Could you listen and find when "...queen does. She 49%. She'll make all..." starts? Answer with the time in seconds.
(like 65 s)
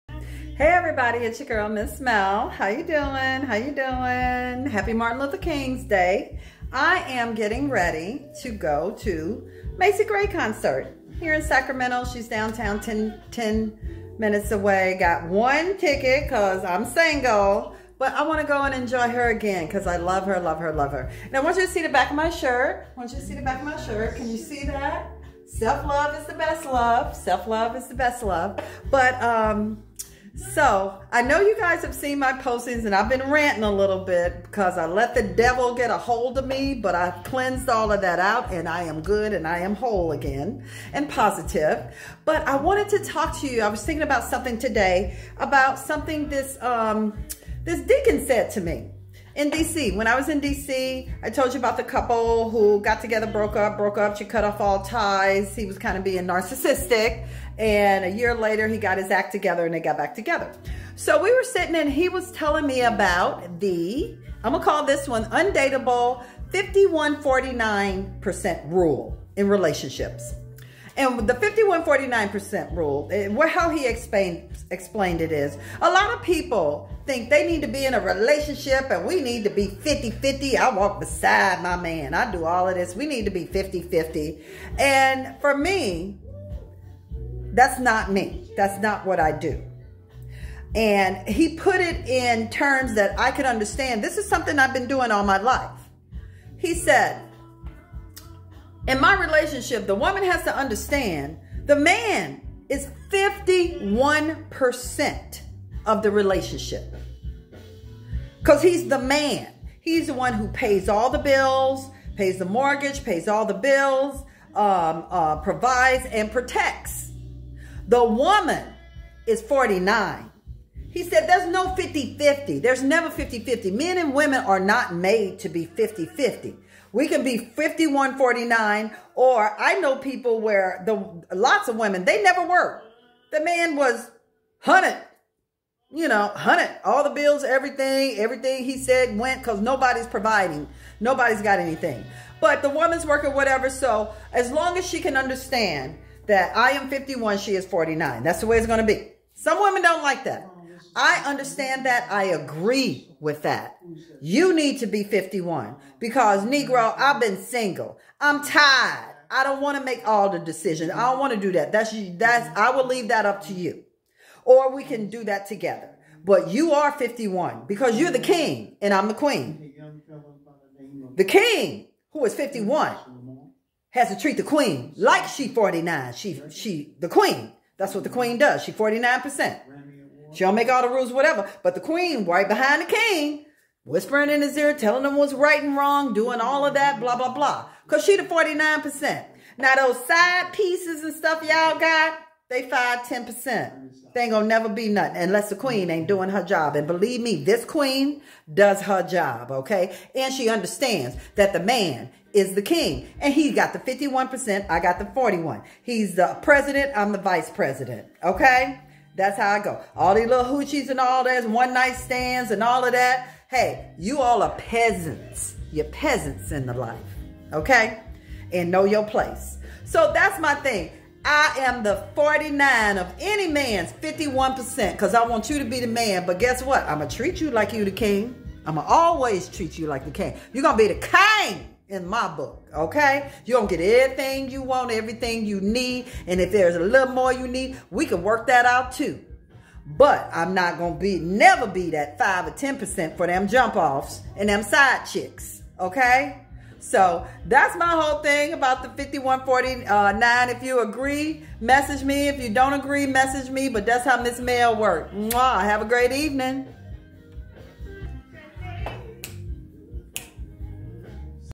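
178 s.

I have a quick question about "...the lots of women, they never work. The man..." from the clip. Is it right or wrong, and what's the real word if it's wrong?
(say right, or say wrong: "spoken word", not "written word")
right.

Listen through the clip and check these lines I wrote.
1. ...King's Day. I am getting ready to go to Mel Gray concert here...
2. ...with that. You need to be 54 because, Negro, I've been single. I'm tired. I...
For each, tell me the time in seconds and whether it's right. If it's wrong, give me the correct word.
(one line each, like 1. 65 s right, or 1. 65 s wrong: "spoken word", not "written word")
1. 5 s wrong: "Macy", not "Mel"
2. 153 s wrong: "51", not "54".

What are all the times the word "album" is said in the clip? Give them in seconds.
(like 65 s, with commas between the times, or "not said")
not said.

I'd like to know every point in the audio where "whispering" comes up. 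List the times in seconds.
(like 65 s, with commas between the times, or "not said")
183 s.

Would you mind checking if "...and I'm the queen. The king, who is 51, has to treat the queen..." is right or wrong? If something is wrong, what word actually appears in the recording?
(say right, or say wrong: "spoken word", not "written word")
right.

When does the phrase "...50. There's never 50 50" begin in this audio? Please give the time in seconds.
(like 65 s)
122 s.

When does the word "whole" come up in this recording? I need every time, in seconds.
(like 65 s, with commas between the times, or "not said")
39 s, 247 s.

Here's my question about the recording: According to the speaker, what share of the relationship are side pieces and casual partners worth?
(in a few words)
5 to 10%.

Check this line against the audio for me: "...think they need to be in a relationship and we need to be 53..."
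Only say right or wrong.
wrong.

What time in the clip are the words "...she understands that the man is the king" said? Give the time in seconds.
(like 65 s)
200 s.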